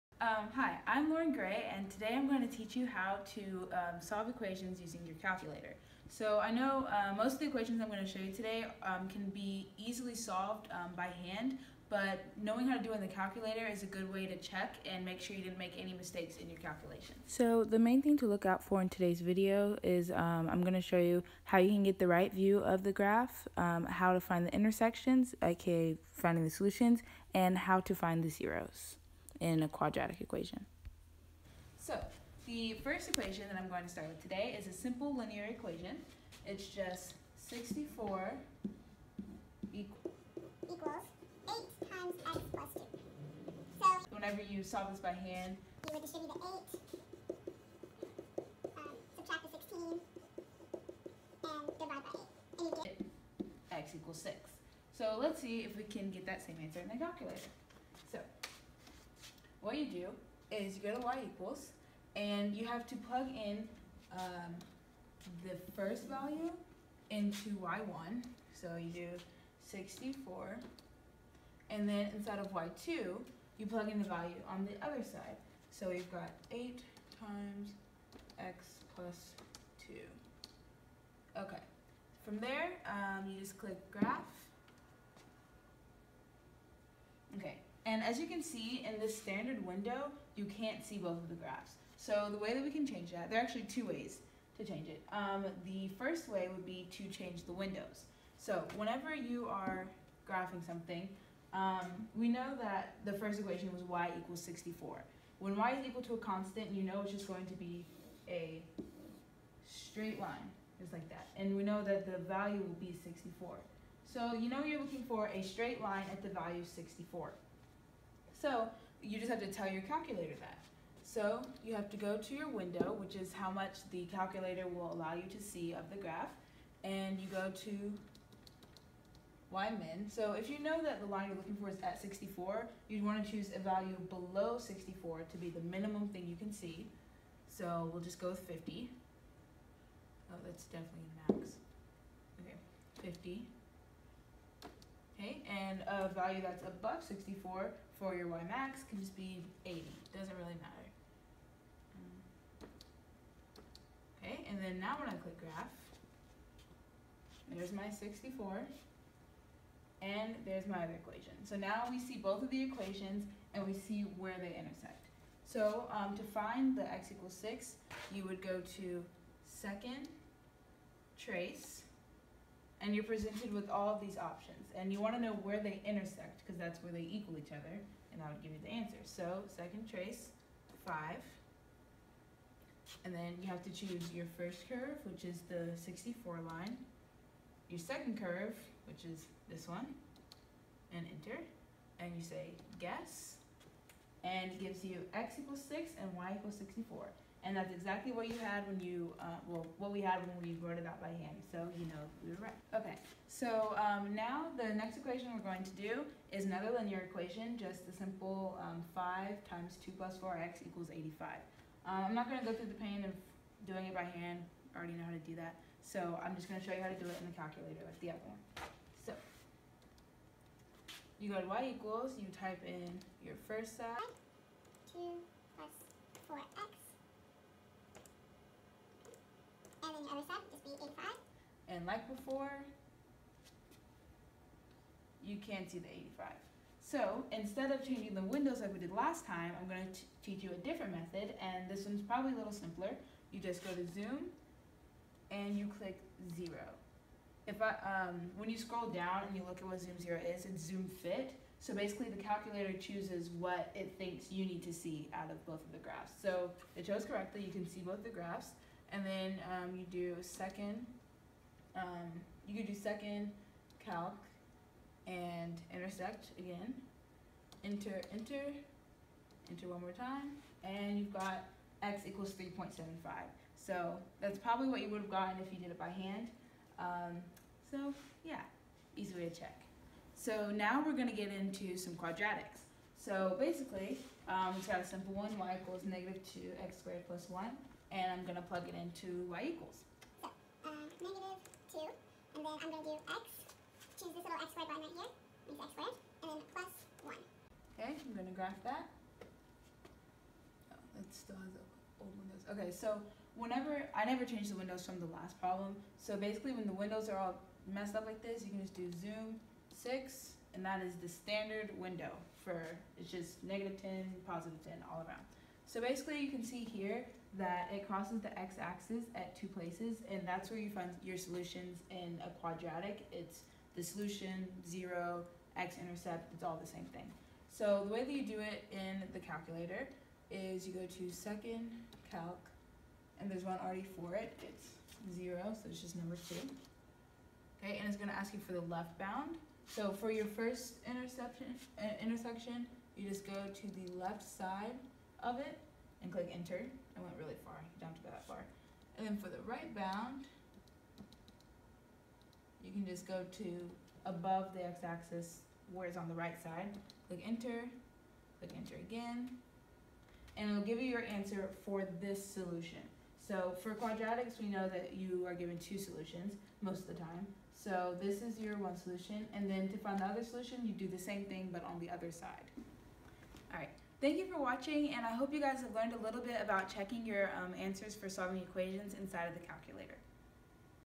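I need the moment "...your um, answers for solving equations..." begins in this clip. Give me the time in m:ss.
6:17.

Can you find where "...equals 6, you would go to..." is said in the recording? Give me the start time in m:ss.
2:47.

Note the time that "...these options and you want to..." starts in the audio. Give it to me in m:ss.
2:54.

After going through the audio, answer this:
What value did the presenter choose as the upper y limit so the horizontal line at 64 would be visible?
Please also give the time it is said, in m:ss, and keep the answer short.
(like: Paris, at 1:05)
80, at 2:28.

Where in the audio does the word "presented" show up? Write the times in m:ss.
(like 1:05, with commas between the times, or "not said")
2:53.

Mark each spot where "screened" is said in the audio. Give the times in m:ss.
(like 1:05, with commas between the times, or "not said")
not said.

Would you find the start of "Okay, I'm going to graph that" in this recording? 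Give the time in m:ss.
4:57.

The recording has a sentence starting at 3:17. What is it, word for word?
And that's exactly what you had when you, uh, well, what we had when we wrote it out by hand.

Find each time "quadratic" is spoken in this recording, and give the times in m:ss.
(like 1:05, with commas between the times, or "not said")
0:29, 4:41, 5:22, 6:03.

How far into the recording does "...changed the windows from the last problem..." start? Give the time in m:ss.
5:04.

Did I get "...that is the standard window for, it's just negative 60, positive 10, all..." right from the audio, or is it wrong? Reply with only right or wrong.
wrong.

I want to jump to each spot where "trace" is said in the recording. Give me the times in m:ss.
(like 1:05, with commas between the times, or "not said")
2:51, 2:59.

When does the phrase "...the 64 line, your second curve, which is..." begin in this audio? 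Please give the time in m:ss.
3:05.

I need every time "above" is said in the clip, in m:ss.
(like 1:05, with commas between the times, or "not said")
2:26, 5:54.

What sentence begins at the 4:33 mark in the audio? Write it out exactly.
So that's probably what you would have gotten if you did it by hand.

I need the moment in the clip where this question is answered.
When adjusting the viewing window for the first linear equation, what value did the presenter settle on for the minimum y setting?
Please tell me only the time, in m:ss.
2:17.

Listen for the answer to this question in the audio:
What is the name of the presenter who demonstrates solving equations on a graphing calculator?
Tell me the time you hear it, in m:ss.
0:01.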